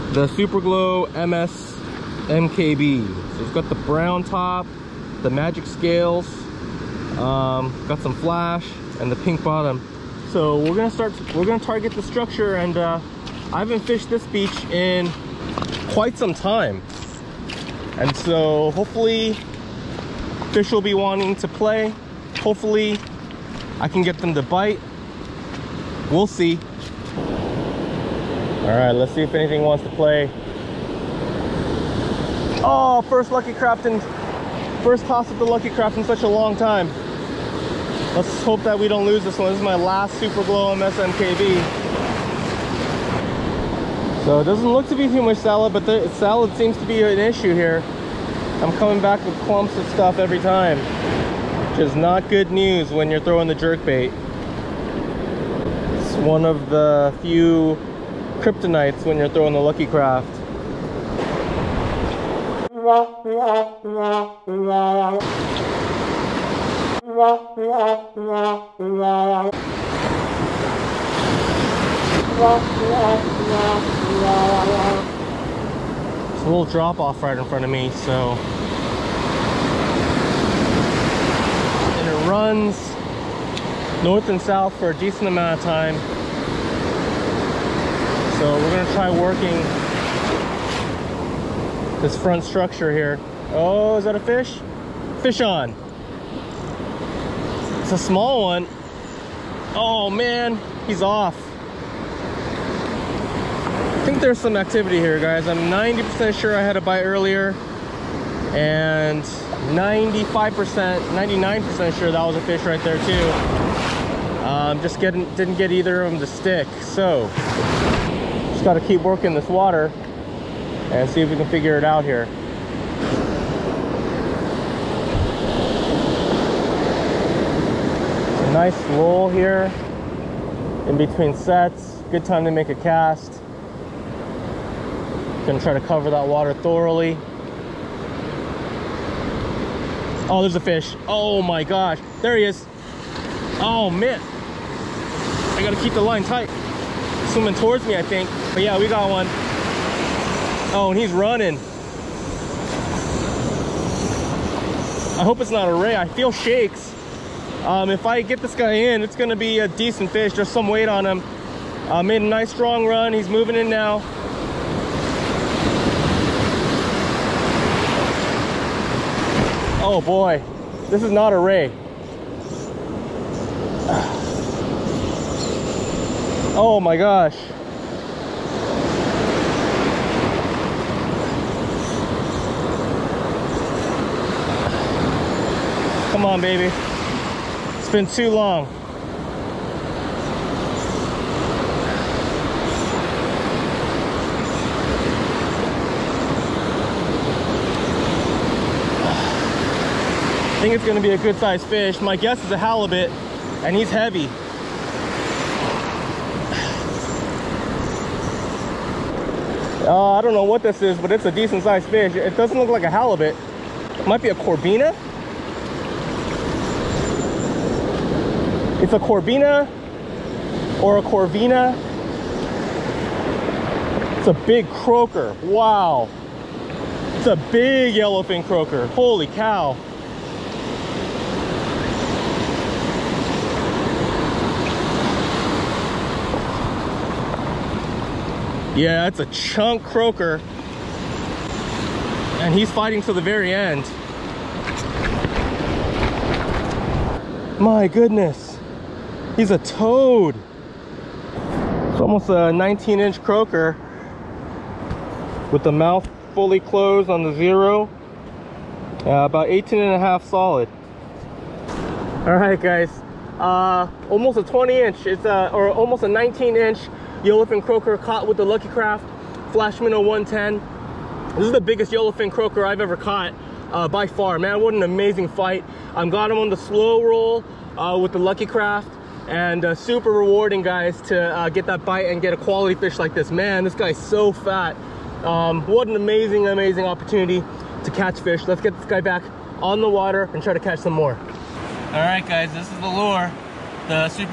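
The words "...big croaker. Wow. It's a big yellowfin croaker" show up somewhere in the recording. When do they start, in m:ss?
3:44.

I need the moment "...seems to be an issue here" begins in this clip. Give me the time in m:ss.
0:46.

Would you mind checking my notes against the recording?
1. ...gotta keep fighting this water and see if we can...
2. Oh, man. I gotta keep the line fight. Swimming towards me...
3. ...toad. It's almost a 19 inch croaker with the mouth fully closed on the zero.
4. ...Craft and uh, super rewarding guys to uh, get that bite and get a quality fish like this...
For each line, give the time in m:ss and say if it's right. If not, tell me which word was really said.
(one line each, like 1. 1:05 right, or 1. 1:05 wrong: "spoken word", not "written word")
1. 1:58 wrong: "working", not "fighting"
2. 2:23 wrong: "tight", not "fight"
3. 4:09 right
4. 4:38 right.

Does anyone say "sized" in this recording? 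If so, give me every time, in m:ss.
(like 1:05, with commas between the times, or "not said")
3:21, 3:31.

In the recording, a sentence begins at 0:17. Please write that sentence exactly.
And so hopefully fish will be wanting to play.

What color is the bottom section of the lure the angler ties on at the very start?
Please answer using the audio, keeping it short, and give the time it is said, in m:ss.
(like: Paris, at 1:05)
Pink, at 0:09.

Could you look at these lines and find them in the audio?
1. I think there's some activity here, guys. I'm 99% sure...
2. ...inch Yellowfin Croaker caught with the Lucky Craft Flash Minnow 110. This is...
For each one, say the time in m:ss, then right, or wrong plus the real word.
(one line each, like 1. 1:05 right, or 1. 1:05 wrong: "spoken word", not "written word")
1. 1:43 wrong: "90", not "99"
2. 4:26 right.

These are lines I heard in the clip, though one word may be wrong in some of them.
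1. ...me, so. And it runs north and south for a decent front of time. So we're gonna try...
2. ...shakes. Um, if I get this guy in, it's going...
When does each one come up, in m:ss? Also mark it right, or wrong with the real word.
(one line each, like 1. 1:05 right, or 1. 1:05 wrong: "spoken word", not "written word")
1. 1:17 wrong: "amount", not "front"
2. 2:36 right.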